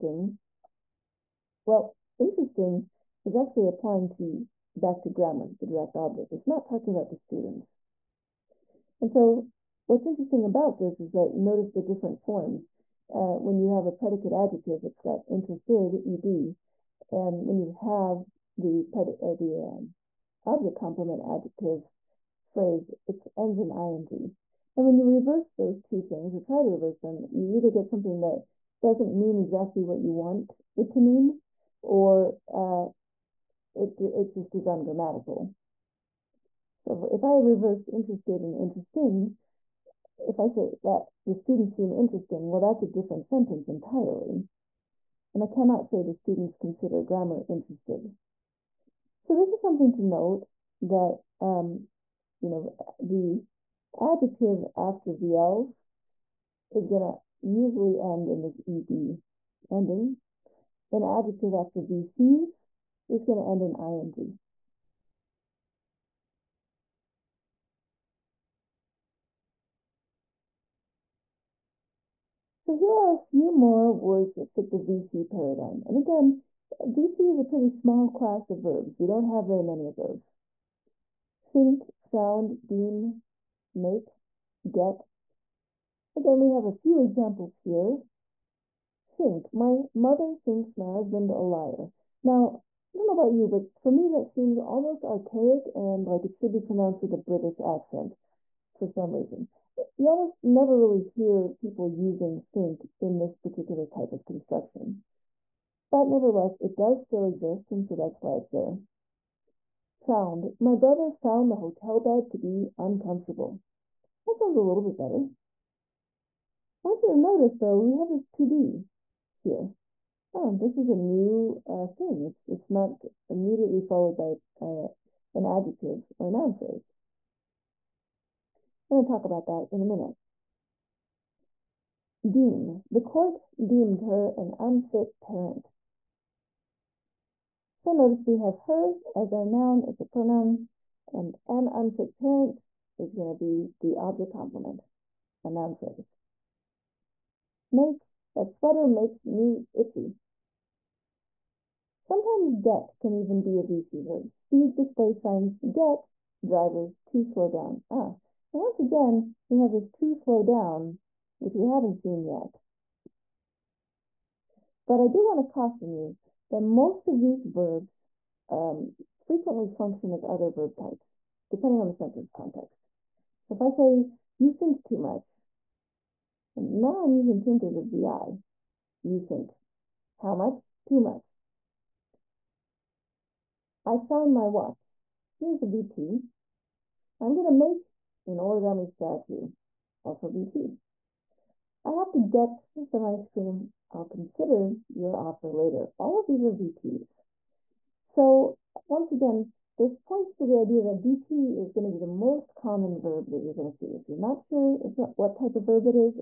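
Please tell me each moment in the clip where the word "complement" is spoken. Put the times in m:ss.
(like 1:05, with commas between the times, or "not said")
0:20, 2:24.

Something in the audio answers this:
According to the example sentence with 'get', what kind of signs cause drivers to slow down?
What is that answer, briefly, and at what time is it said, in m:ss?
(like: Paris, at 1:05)
Speed display signs, at 2:34.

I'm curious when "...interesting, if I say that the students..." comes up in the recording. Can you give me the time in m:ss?
0:38.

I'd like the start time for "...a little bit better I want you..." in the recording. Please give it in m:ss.
1:54.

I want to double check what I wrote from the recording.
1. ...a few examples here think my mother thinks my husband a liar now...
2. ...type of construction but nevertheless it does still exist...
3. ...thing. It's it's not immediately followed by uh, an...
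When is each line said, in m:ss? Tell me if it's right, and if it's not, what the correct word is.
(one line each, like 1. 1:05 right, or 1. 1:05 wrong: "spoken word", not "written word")
1. 1:26 right
2. 1:43 right
3. 2:01 right.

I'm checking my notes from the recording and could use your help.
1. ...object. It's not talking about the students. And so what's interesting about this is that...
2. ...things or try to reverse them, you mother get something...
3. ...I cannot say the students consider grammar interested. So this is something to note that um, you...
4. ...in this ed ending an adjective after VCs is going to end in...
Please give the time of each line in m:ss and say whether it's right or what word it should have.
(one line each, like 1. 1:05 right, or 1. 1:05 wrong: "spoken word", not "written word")
1. 0:05 right
2. 0:26 wrong: "either", not "mother"
3. 0:45 right
4. 0:58 right.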